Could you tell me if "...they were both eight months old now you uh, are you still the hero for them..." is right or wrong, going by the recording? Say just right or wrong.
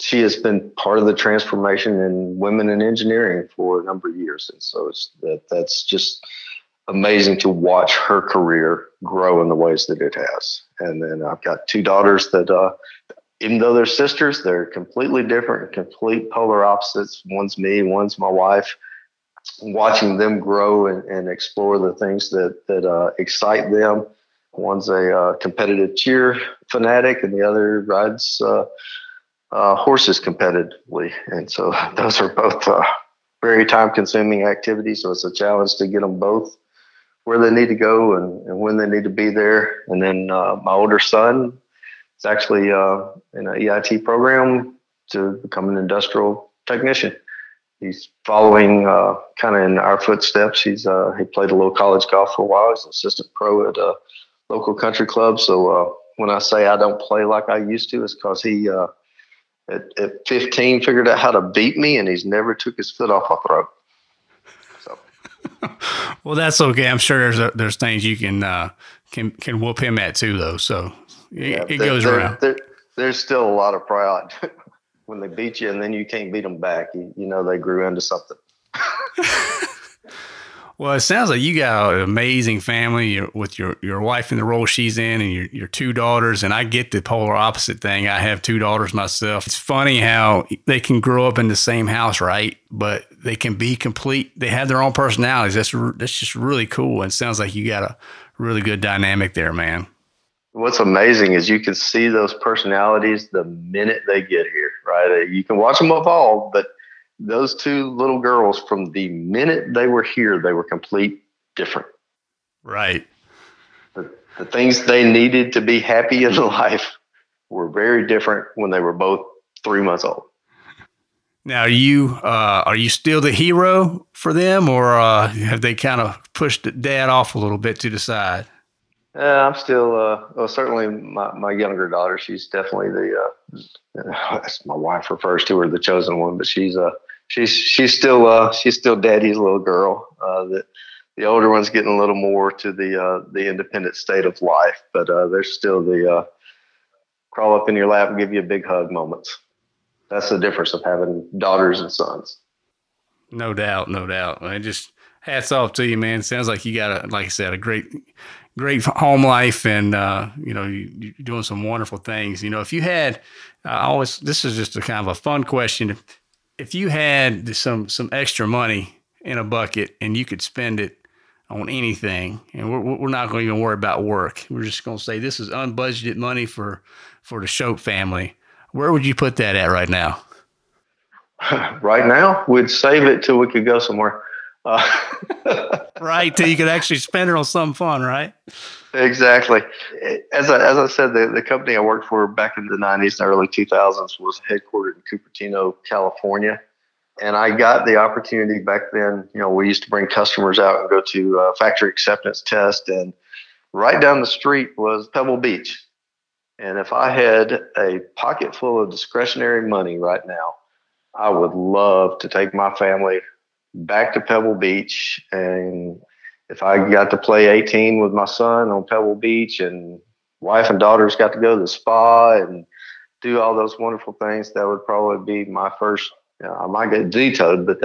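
wrong.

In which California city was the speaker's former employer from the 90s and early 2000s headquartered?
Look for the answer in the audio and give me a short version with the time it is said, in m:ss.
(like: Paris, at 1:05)
Cupertino, at 3:15.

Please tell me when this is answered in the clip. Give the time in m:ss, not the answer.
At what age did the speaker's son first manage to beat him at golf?
1:00.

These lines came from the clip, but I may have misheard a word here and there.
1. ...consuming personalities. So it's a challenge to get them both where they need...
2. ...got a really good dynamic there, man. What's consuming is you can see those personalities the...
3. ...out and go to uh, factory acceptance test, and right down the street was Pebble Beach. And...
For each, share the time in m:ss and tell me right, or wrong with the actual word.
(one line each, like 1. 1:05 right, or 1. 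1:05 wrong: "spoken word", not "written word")
1. 0:33 wrong: "activities", not "personalities"
2. 1:37 wrong: "amazing", not "consuming"
3. 3:20 right.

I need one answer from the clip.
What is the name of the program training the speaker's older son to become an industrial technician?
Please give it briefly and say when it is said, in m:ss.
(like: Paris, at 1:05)
EIT program, at 0:43.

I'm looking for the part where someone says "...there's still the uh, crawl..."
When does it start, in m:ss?
2:25.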